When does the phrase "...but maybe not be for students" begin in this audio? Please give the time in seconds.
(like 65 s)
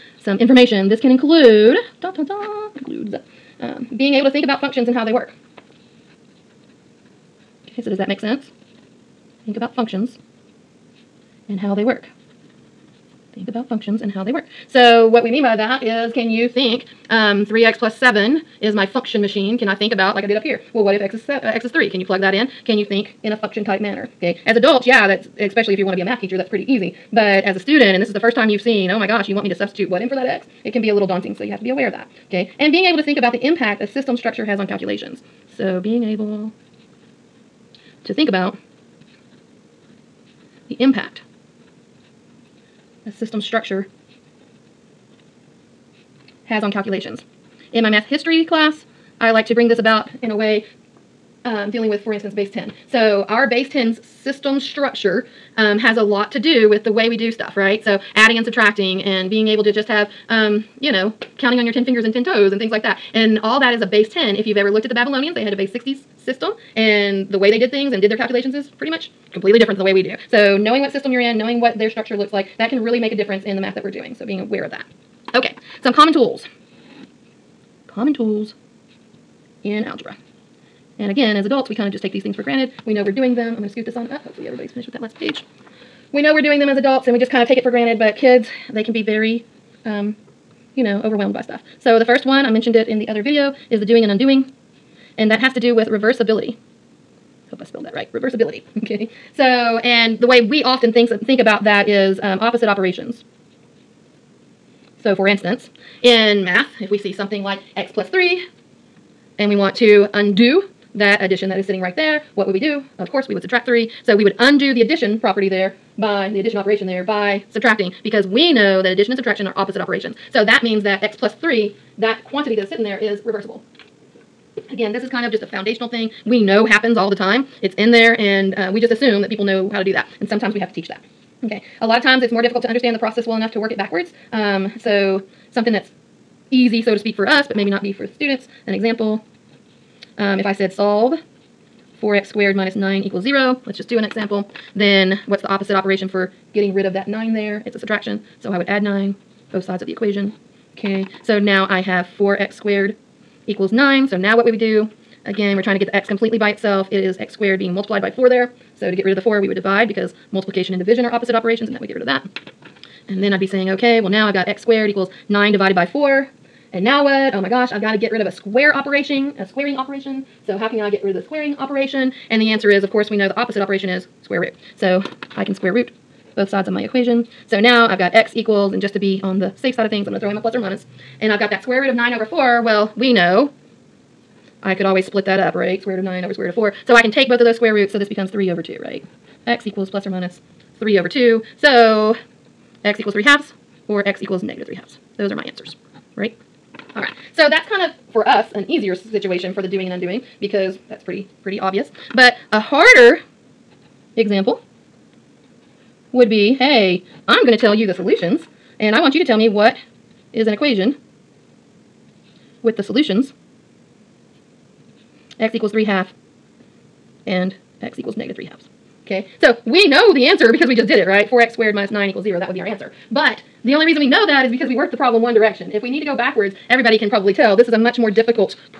137 s.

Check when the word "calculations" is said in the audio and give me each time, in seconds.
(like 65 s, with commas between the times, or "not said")
34 s, 46 s, 68 s.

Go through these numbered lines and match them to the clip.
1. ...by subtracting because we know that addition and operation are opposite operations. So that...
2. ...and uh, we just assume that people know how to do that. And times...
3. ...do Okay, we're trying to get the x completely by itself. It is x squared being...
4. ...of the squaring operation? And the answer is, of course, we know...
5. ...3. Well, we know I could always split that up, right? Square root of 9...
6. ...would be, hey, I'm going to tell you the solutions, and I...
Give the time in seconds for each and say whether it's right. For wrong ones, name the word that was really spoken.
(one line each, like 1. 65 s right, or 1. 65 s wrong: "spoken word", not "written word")
1. 117 s wrong: "subtraction", not "operation"
2. 128 s wrong: "sometimes", not "times"
3. 154 s wrong: "Again", not "Okay"
4. 171 s right
5. 182 s wrong: "4", not "3"
6. 206 s right.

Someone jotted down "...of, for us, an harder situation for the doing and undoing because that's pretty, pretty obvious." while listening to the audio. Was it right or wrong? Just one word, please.
wrong.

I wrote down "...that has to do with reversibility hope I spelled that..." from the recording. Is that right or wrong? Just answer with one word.
right.